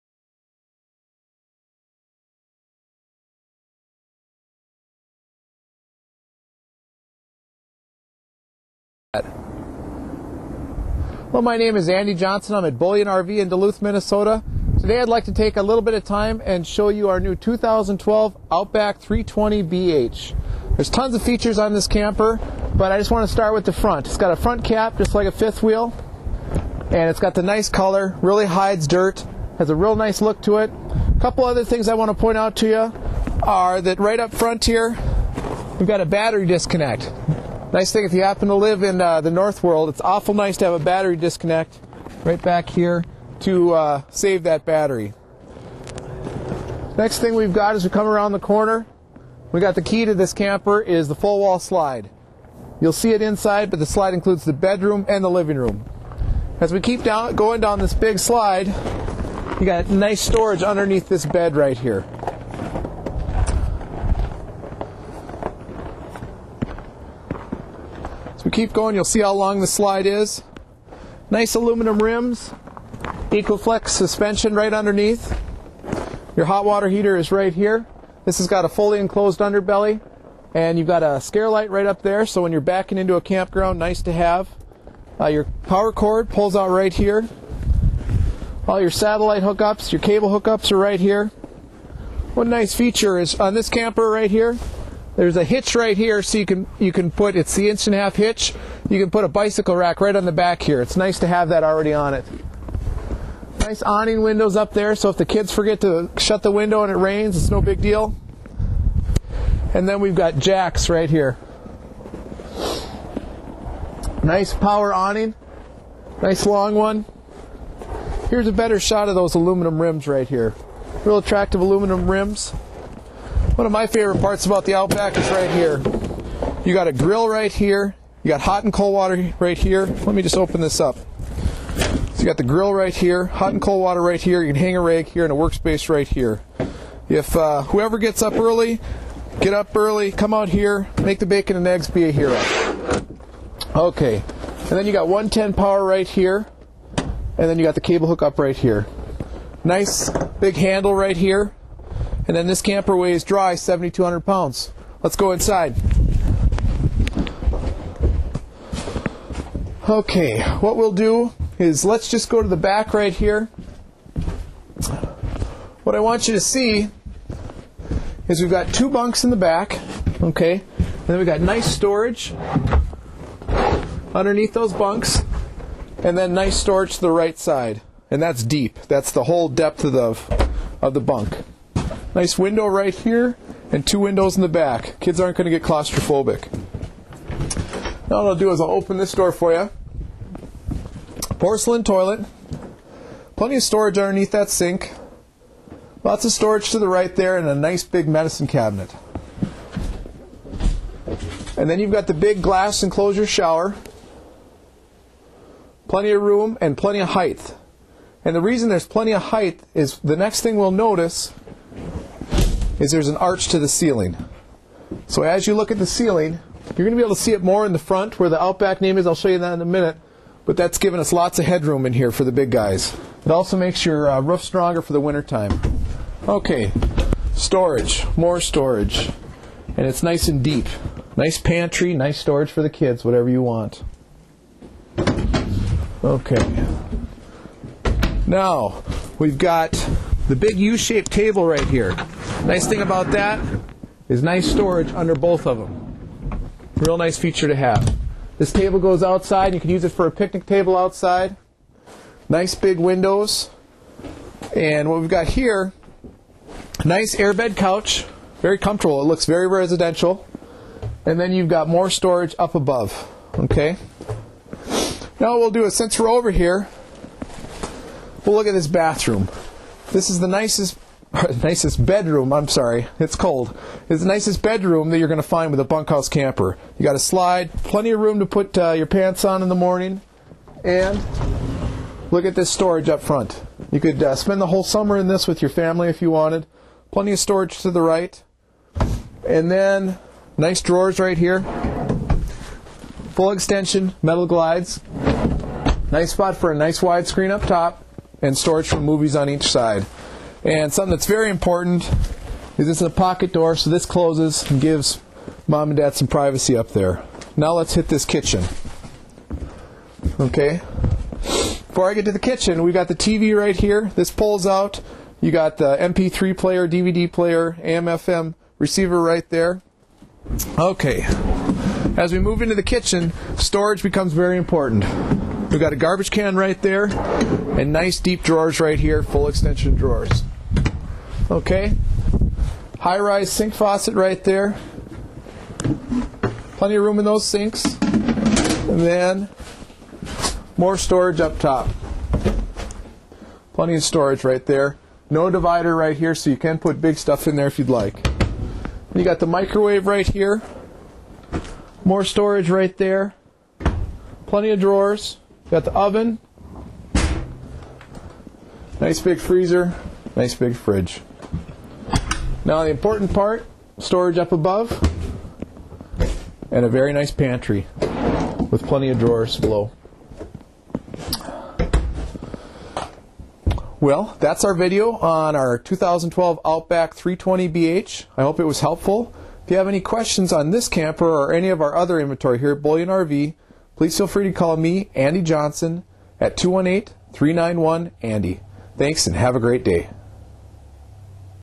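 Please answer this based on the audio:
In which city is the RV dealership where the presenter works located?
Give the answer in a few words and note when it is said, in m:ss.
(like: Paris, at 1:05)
Duluth, Minnesota, at 0:13.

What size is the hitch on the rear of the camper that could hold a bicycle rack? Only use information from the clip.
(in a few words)
inch and a half.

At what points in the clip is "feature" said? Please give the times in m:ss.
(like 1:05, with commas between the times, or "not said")
0:21, 1:32, 4:07.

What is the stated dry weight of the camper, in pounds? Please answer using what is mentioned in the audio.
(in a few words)
7,200.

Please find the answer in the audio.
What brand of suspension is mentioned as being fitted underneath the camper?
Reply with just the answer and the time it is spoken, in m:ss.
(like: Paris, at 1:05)
Equa-Flex, at 1:13.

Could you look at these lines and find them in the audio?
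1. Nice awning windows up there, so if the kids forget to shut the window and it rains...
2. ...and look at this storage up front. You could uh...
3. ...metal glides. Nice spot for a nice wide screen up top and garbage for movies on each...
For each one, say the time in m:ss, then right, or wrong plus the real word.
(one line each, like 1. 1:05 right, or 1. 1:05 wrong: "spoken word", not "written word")
1. 1:43 right
2. 4:40 right
3. 4:54 wrong: "storage", not "garbage".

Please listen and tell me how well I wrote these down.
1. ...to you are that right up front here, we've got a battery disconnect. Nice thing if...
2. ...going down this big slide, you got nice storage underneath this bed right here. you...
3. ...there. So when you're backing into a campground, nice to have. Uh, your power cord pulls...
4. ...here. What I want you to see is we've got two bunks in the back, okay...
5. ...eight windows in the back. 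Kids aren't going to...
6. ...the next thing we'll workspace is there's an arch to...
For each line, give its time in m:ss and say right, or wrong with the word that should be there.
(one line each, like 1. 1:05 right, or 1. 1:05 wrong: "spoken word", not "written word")
1. 0:32 right
2. 0:57 right
3. 1:22 right
4. 2:43 right
5. 3:03 wrong: "two", not "eight"
6. 3:29 wrong: "notice", not "workspace".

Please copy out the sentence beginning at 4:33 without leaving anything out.
It's the nicest bedroom that you're going to find with a bunkhouse camper.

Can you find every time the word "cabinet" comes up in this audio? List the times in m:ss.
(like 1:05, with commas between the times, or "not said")
3:18.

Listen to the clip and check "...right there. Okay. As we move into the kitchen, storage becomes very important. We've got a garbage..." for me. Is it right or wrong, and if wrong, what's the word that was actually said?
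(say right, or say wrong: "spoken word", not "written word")
right.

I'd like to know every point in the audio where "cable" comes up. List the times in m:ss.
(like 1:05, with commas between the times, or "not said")
1:30, 2:27.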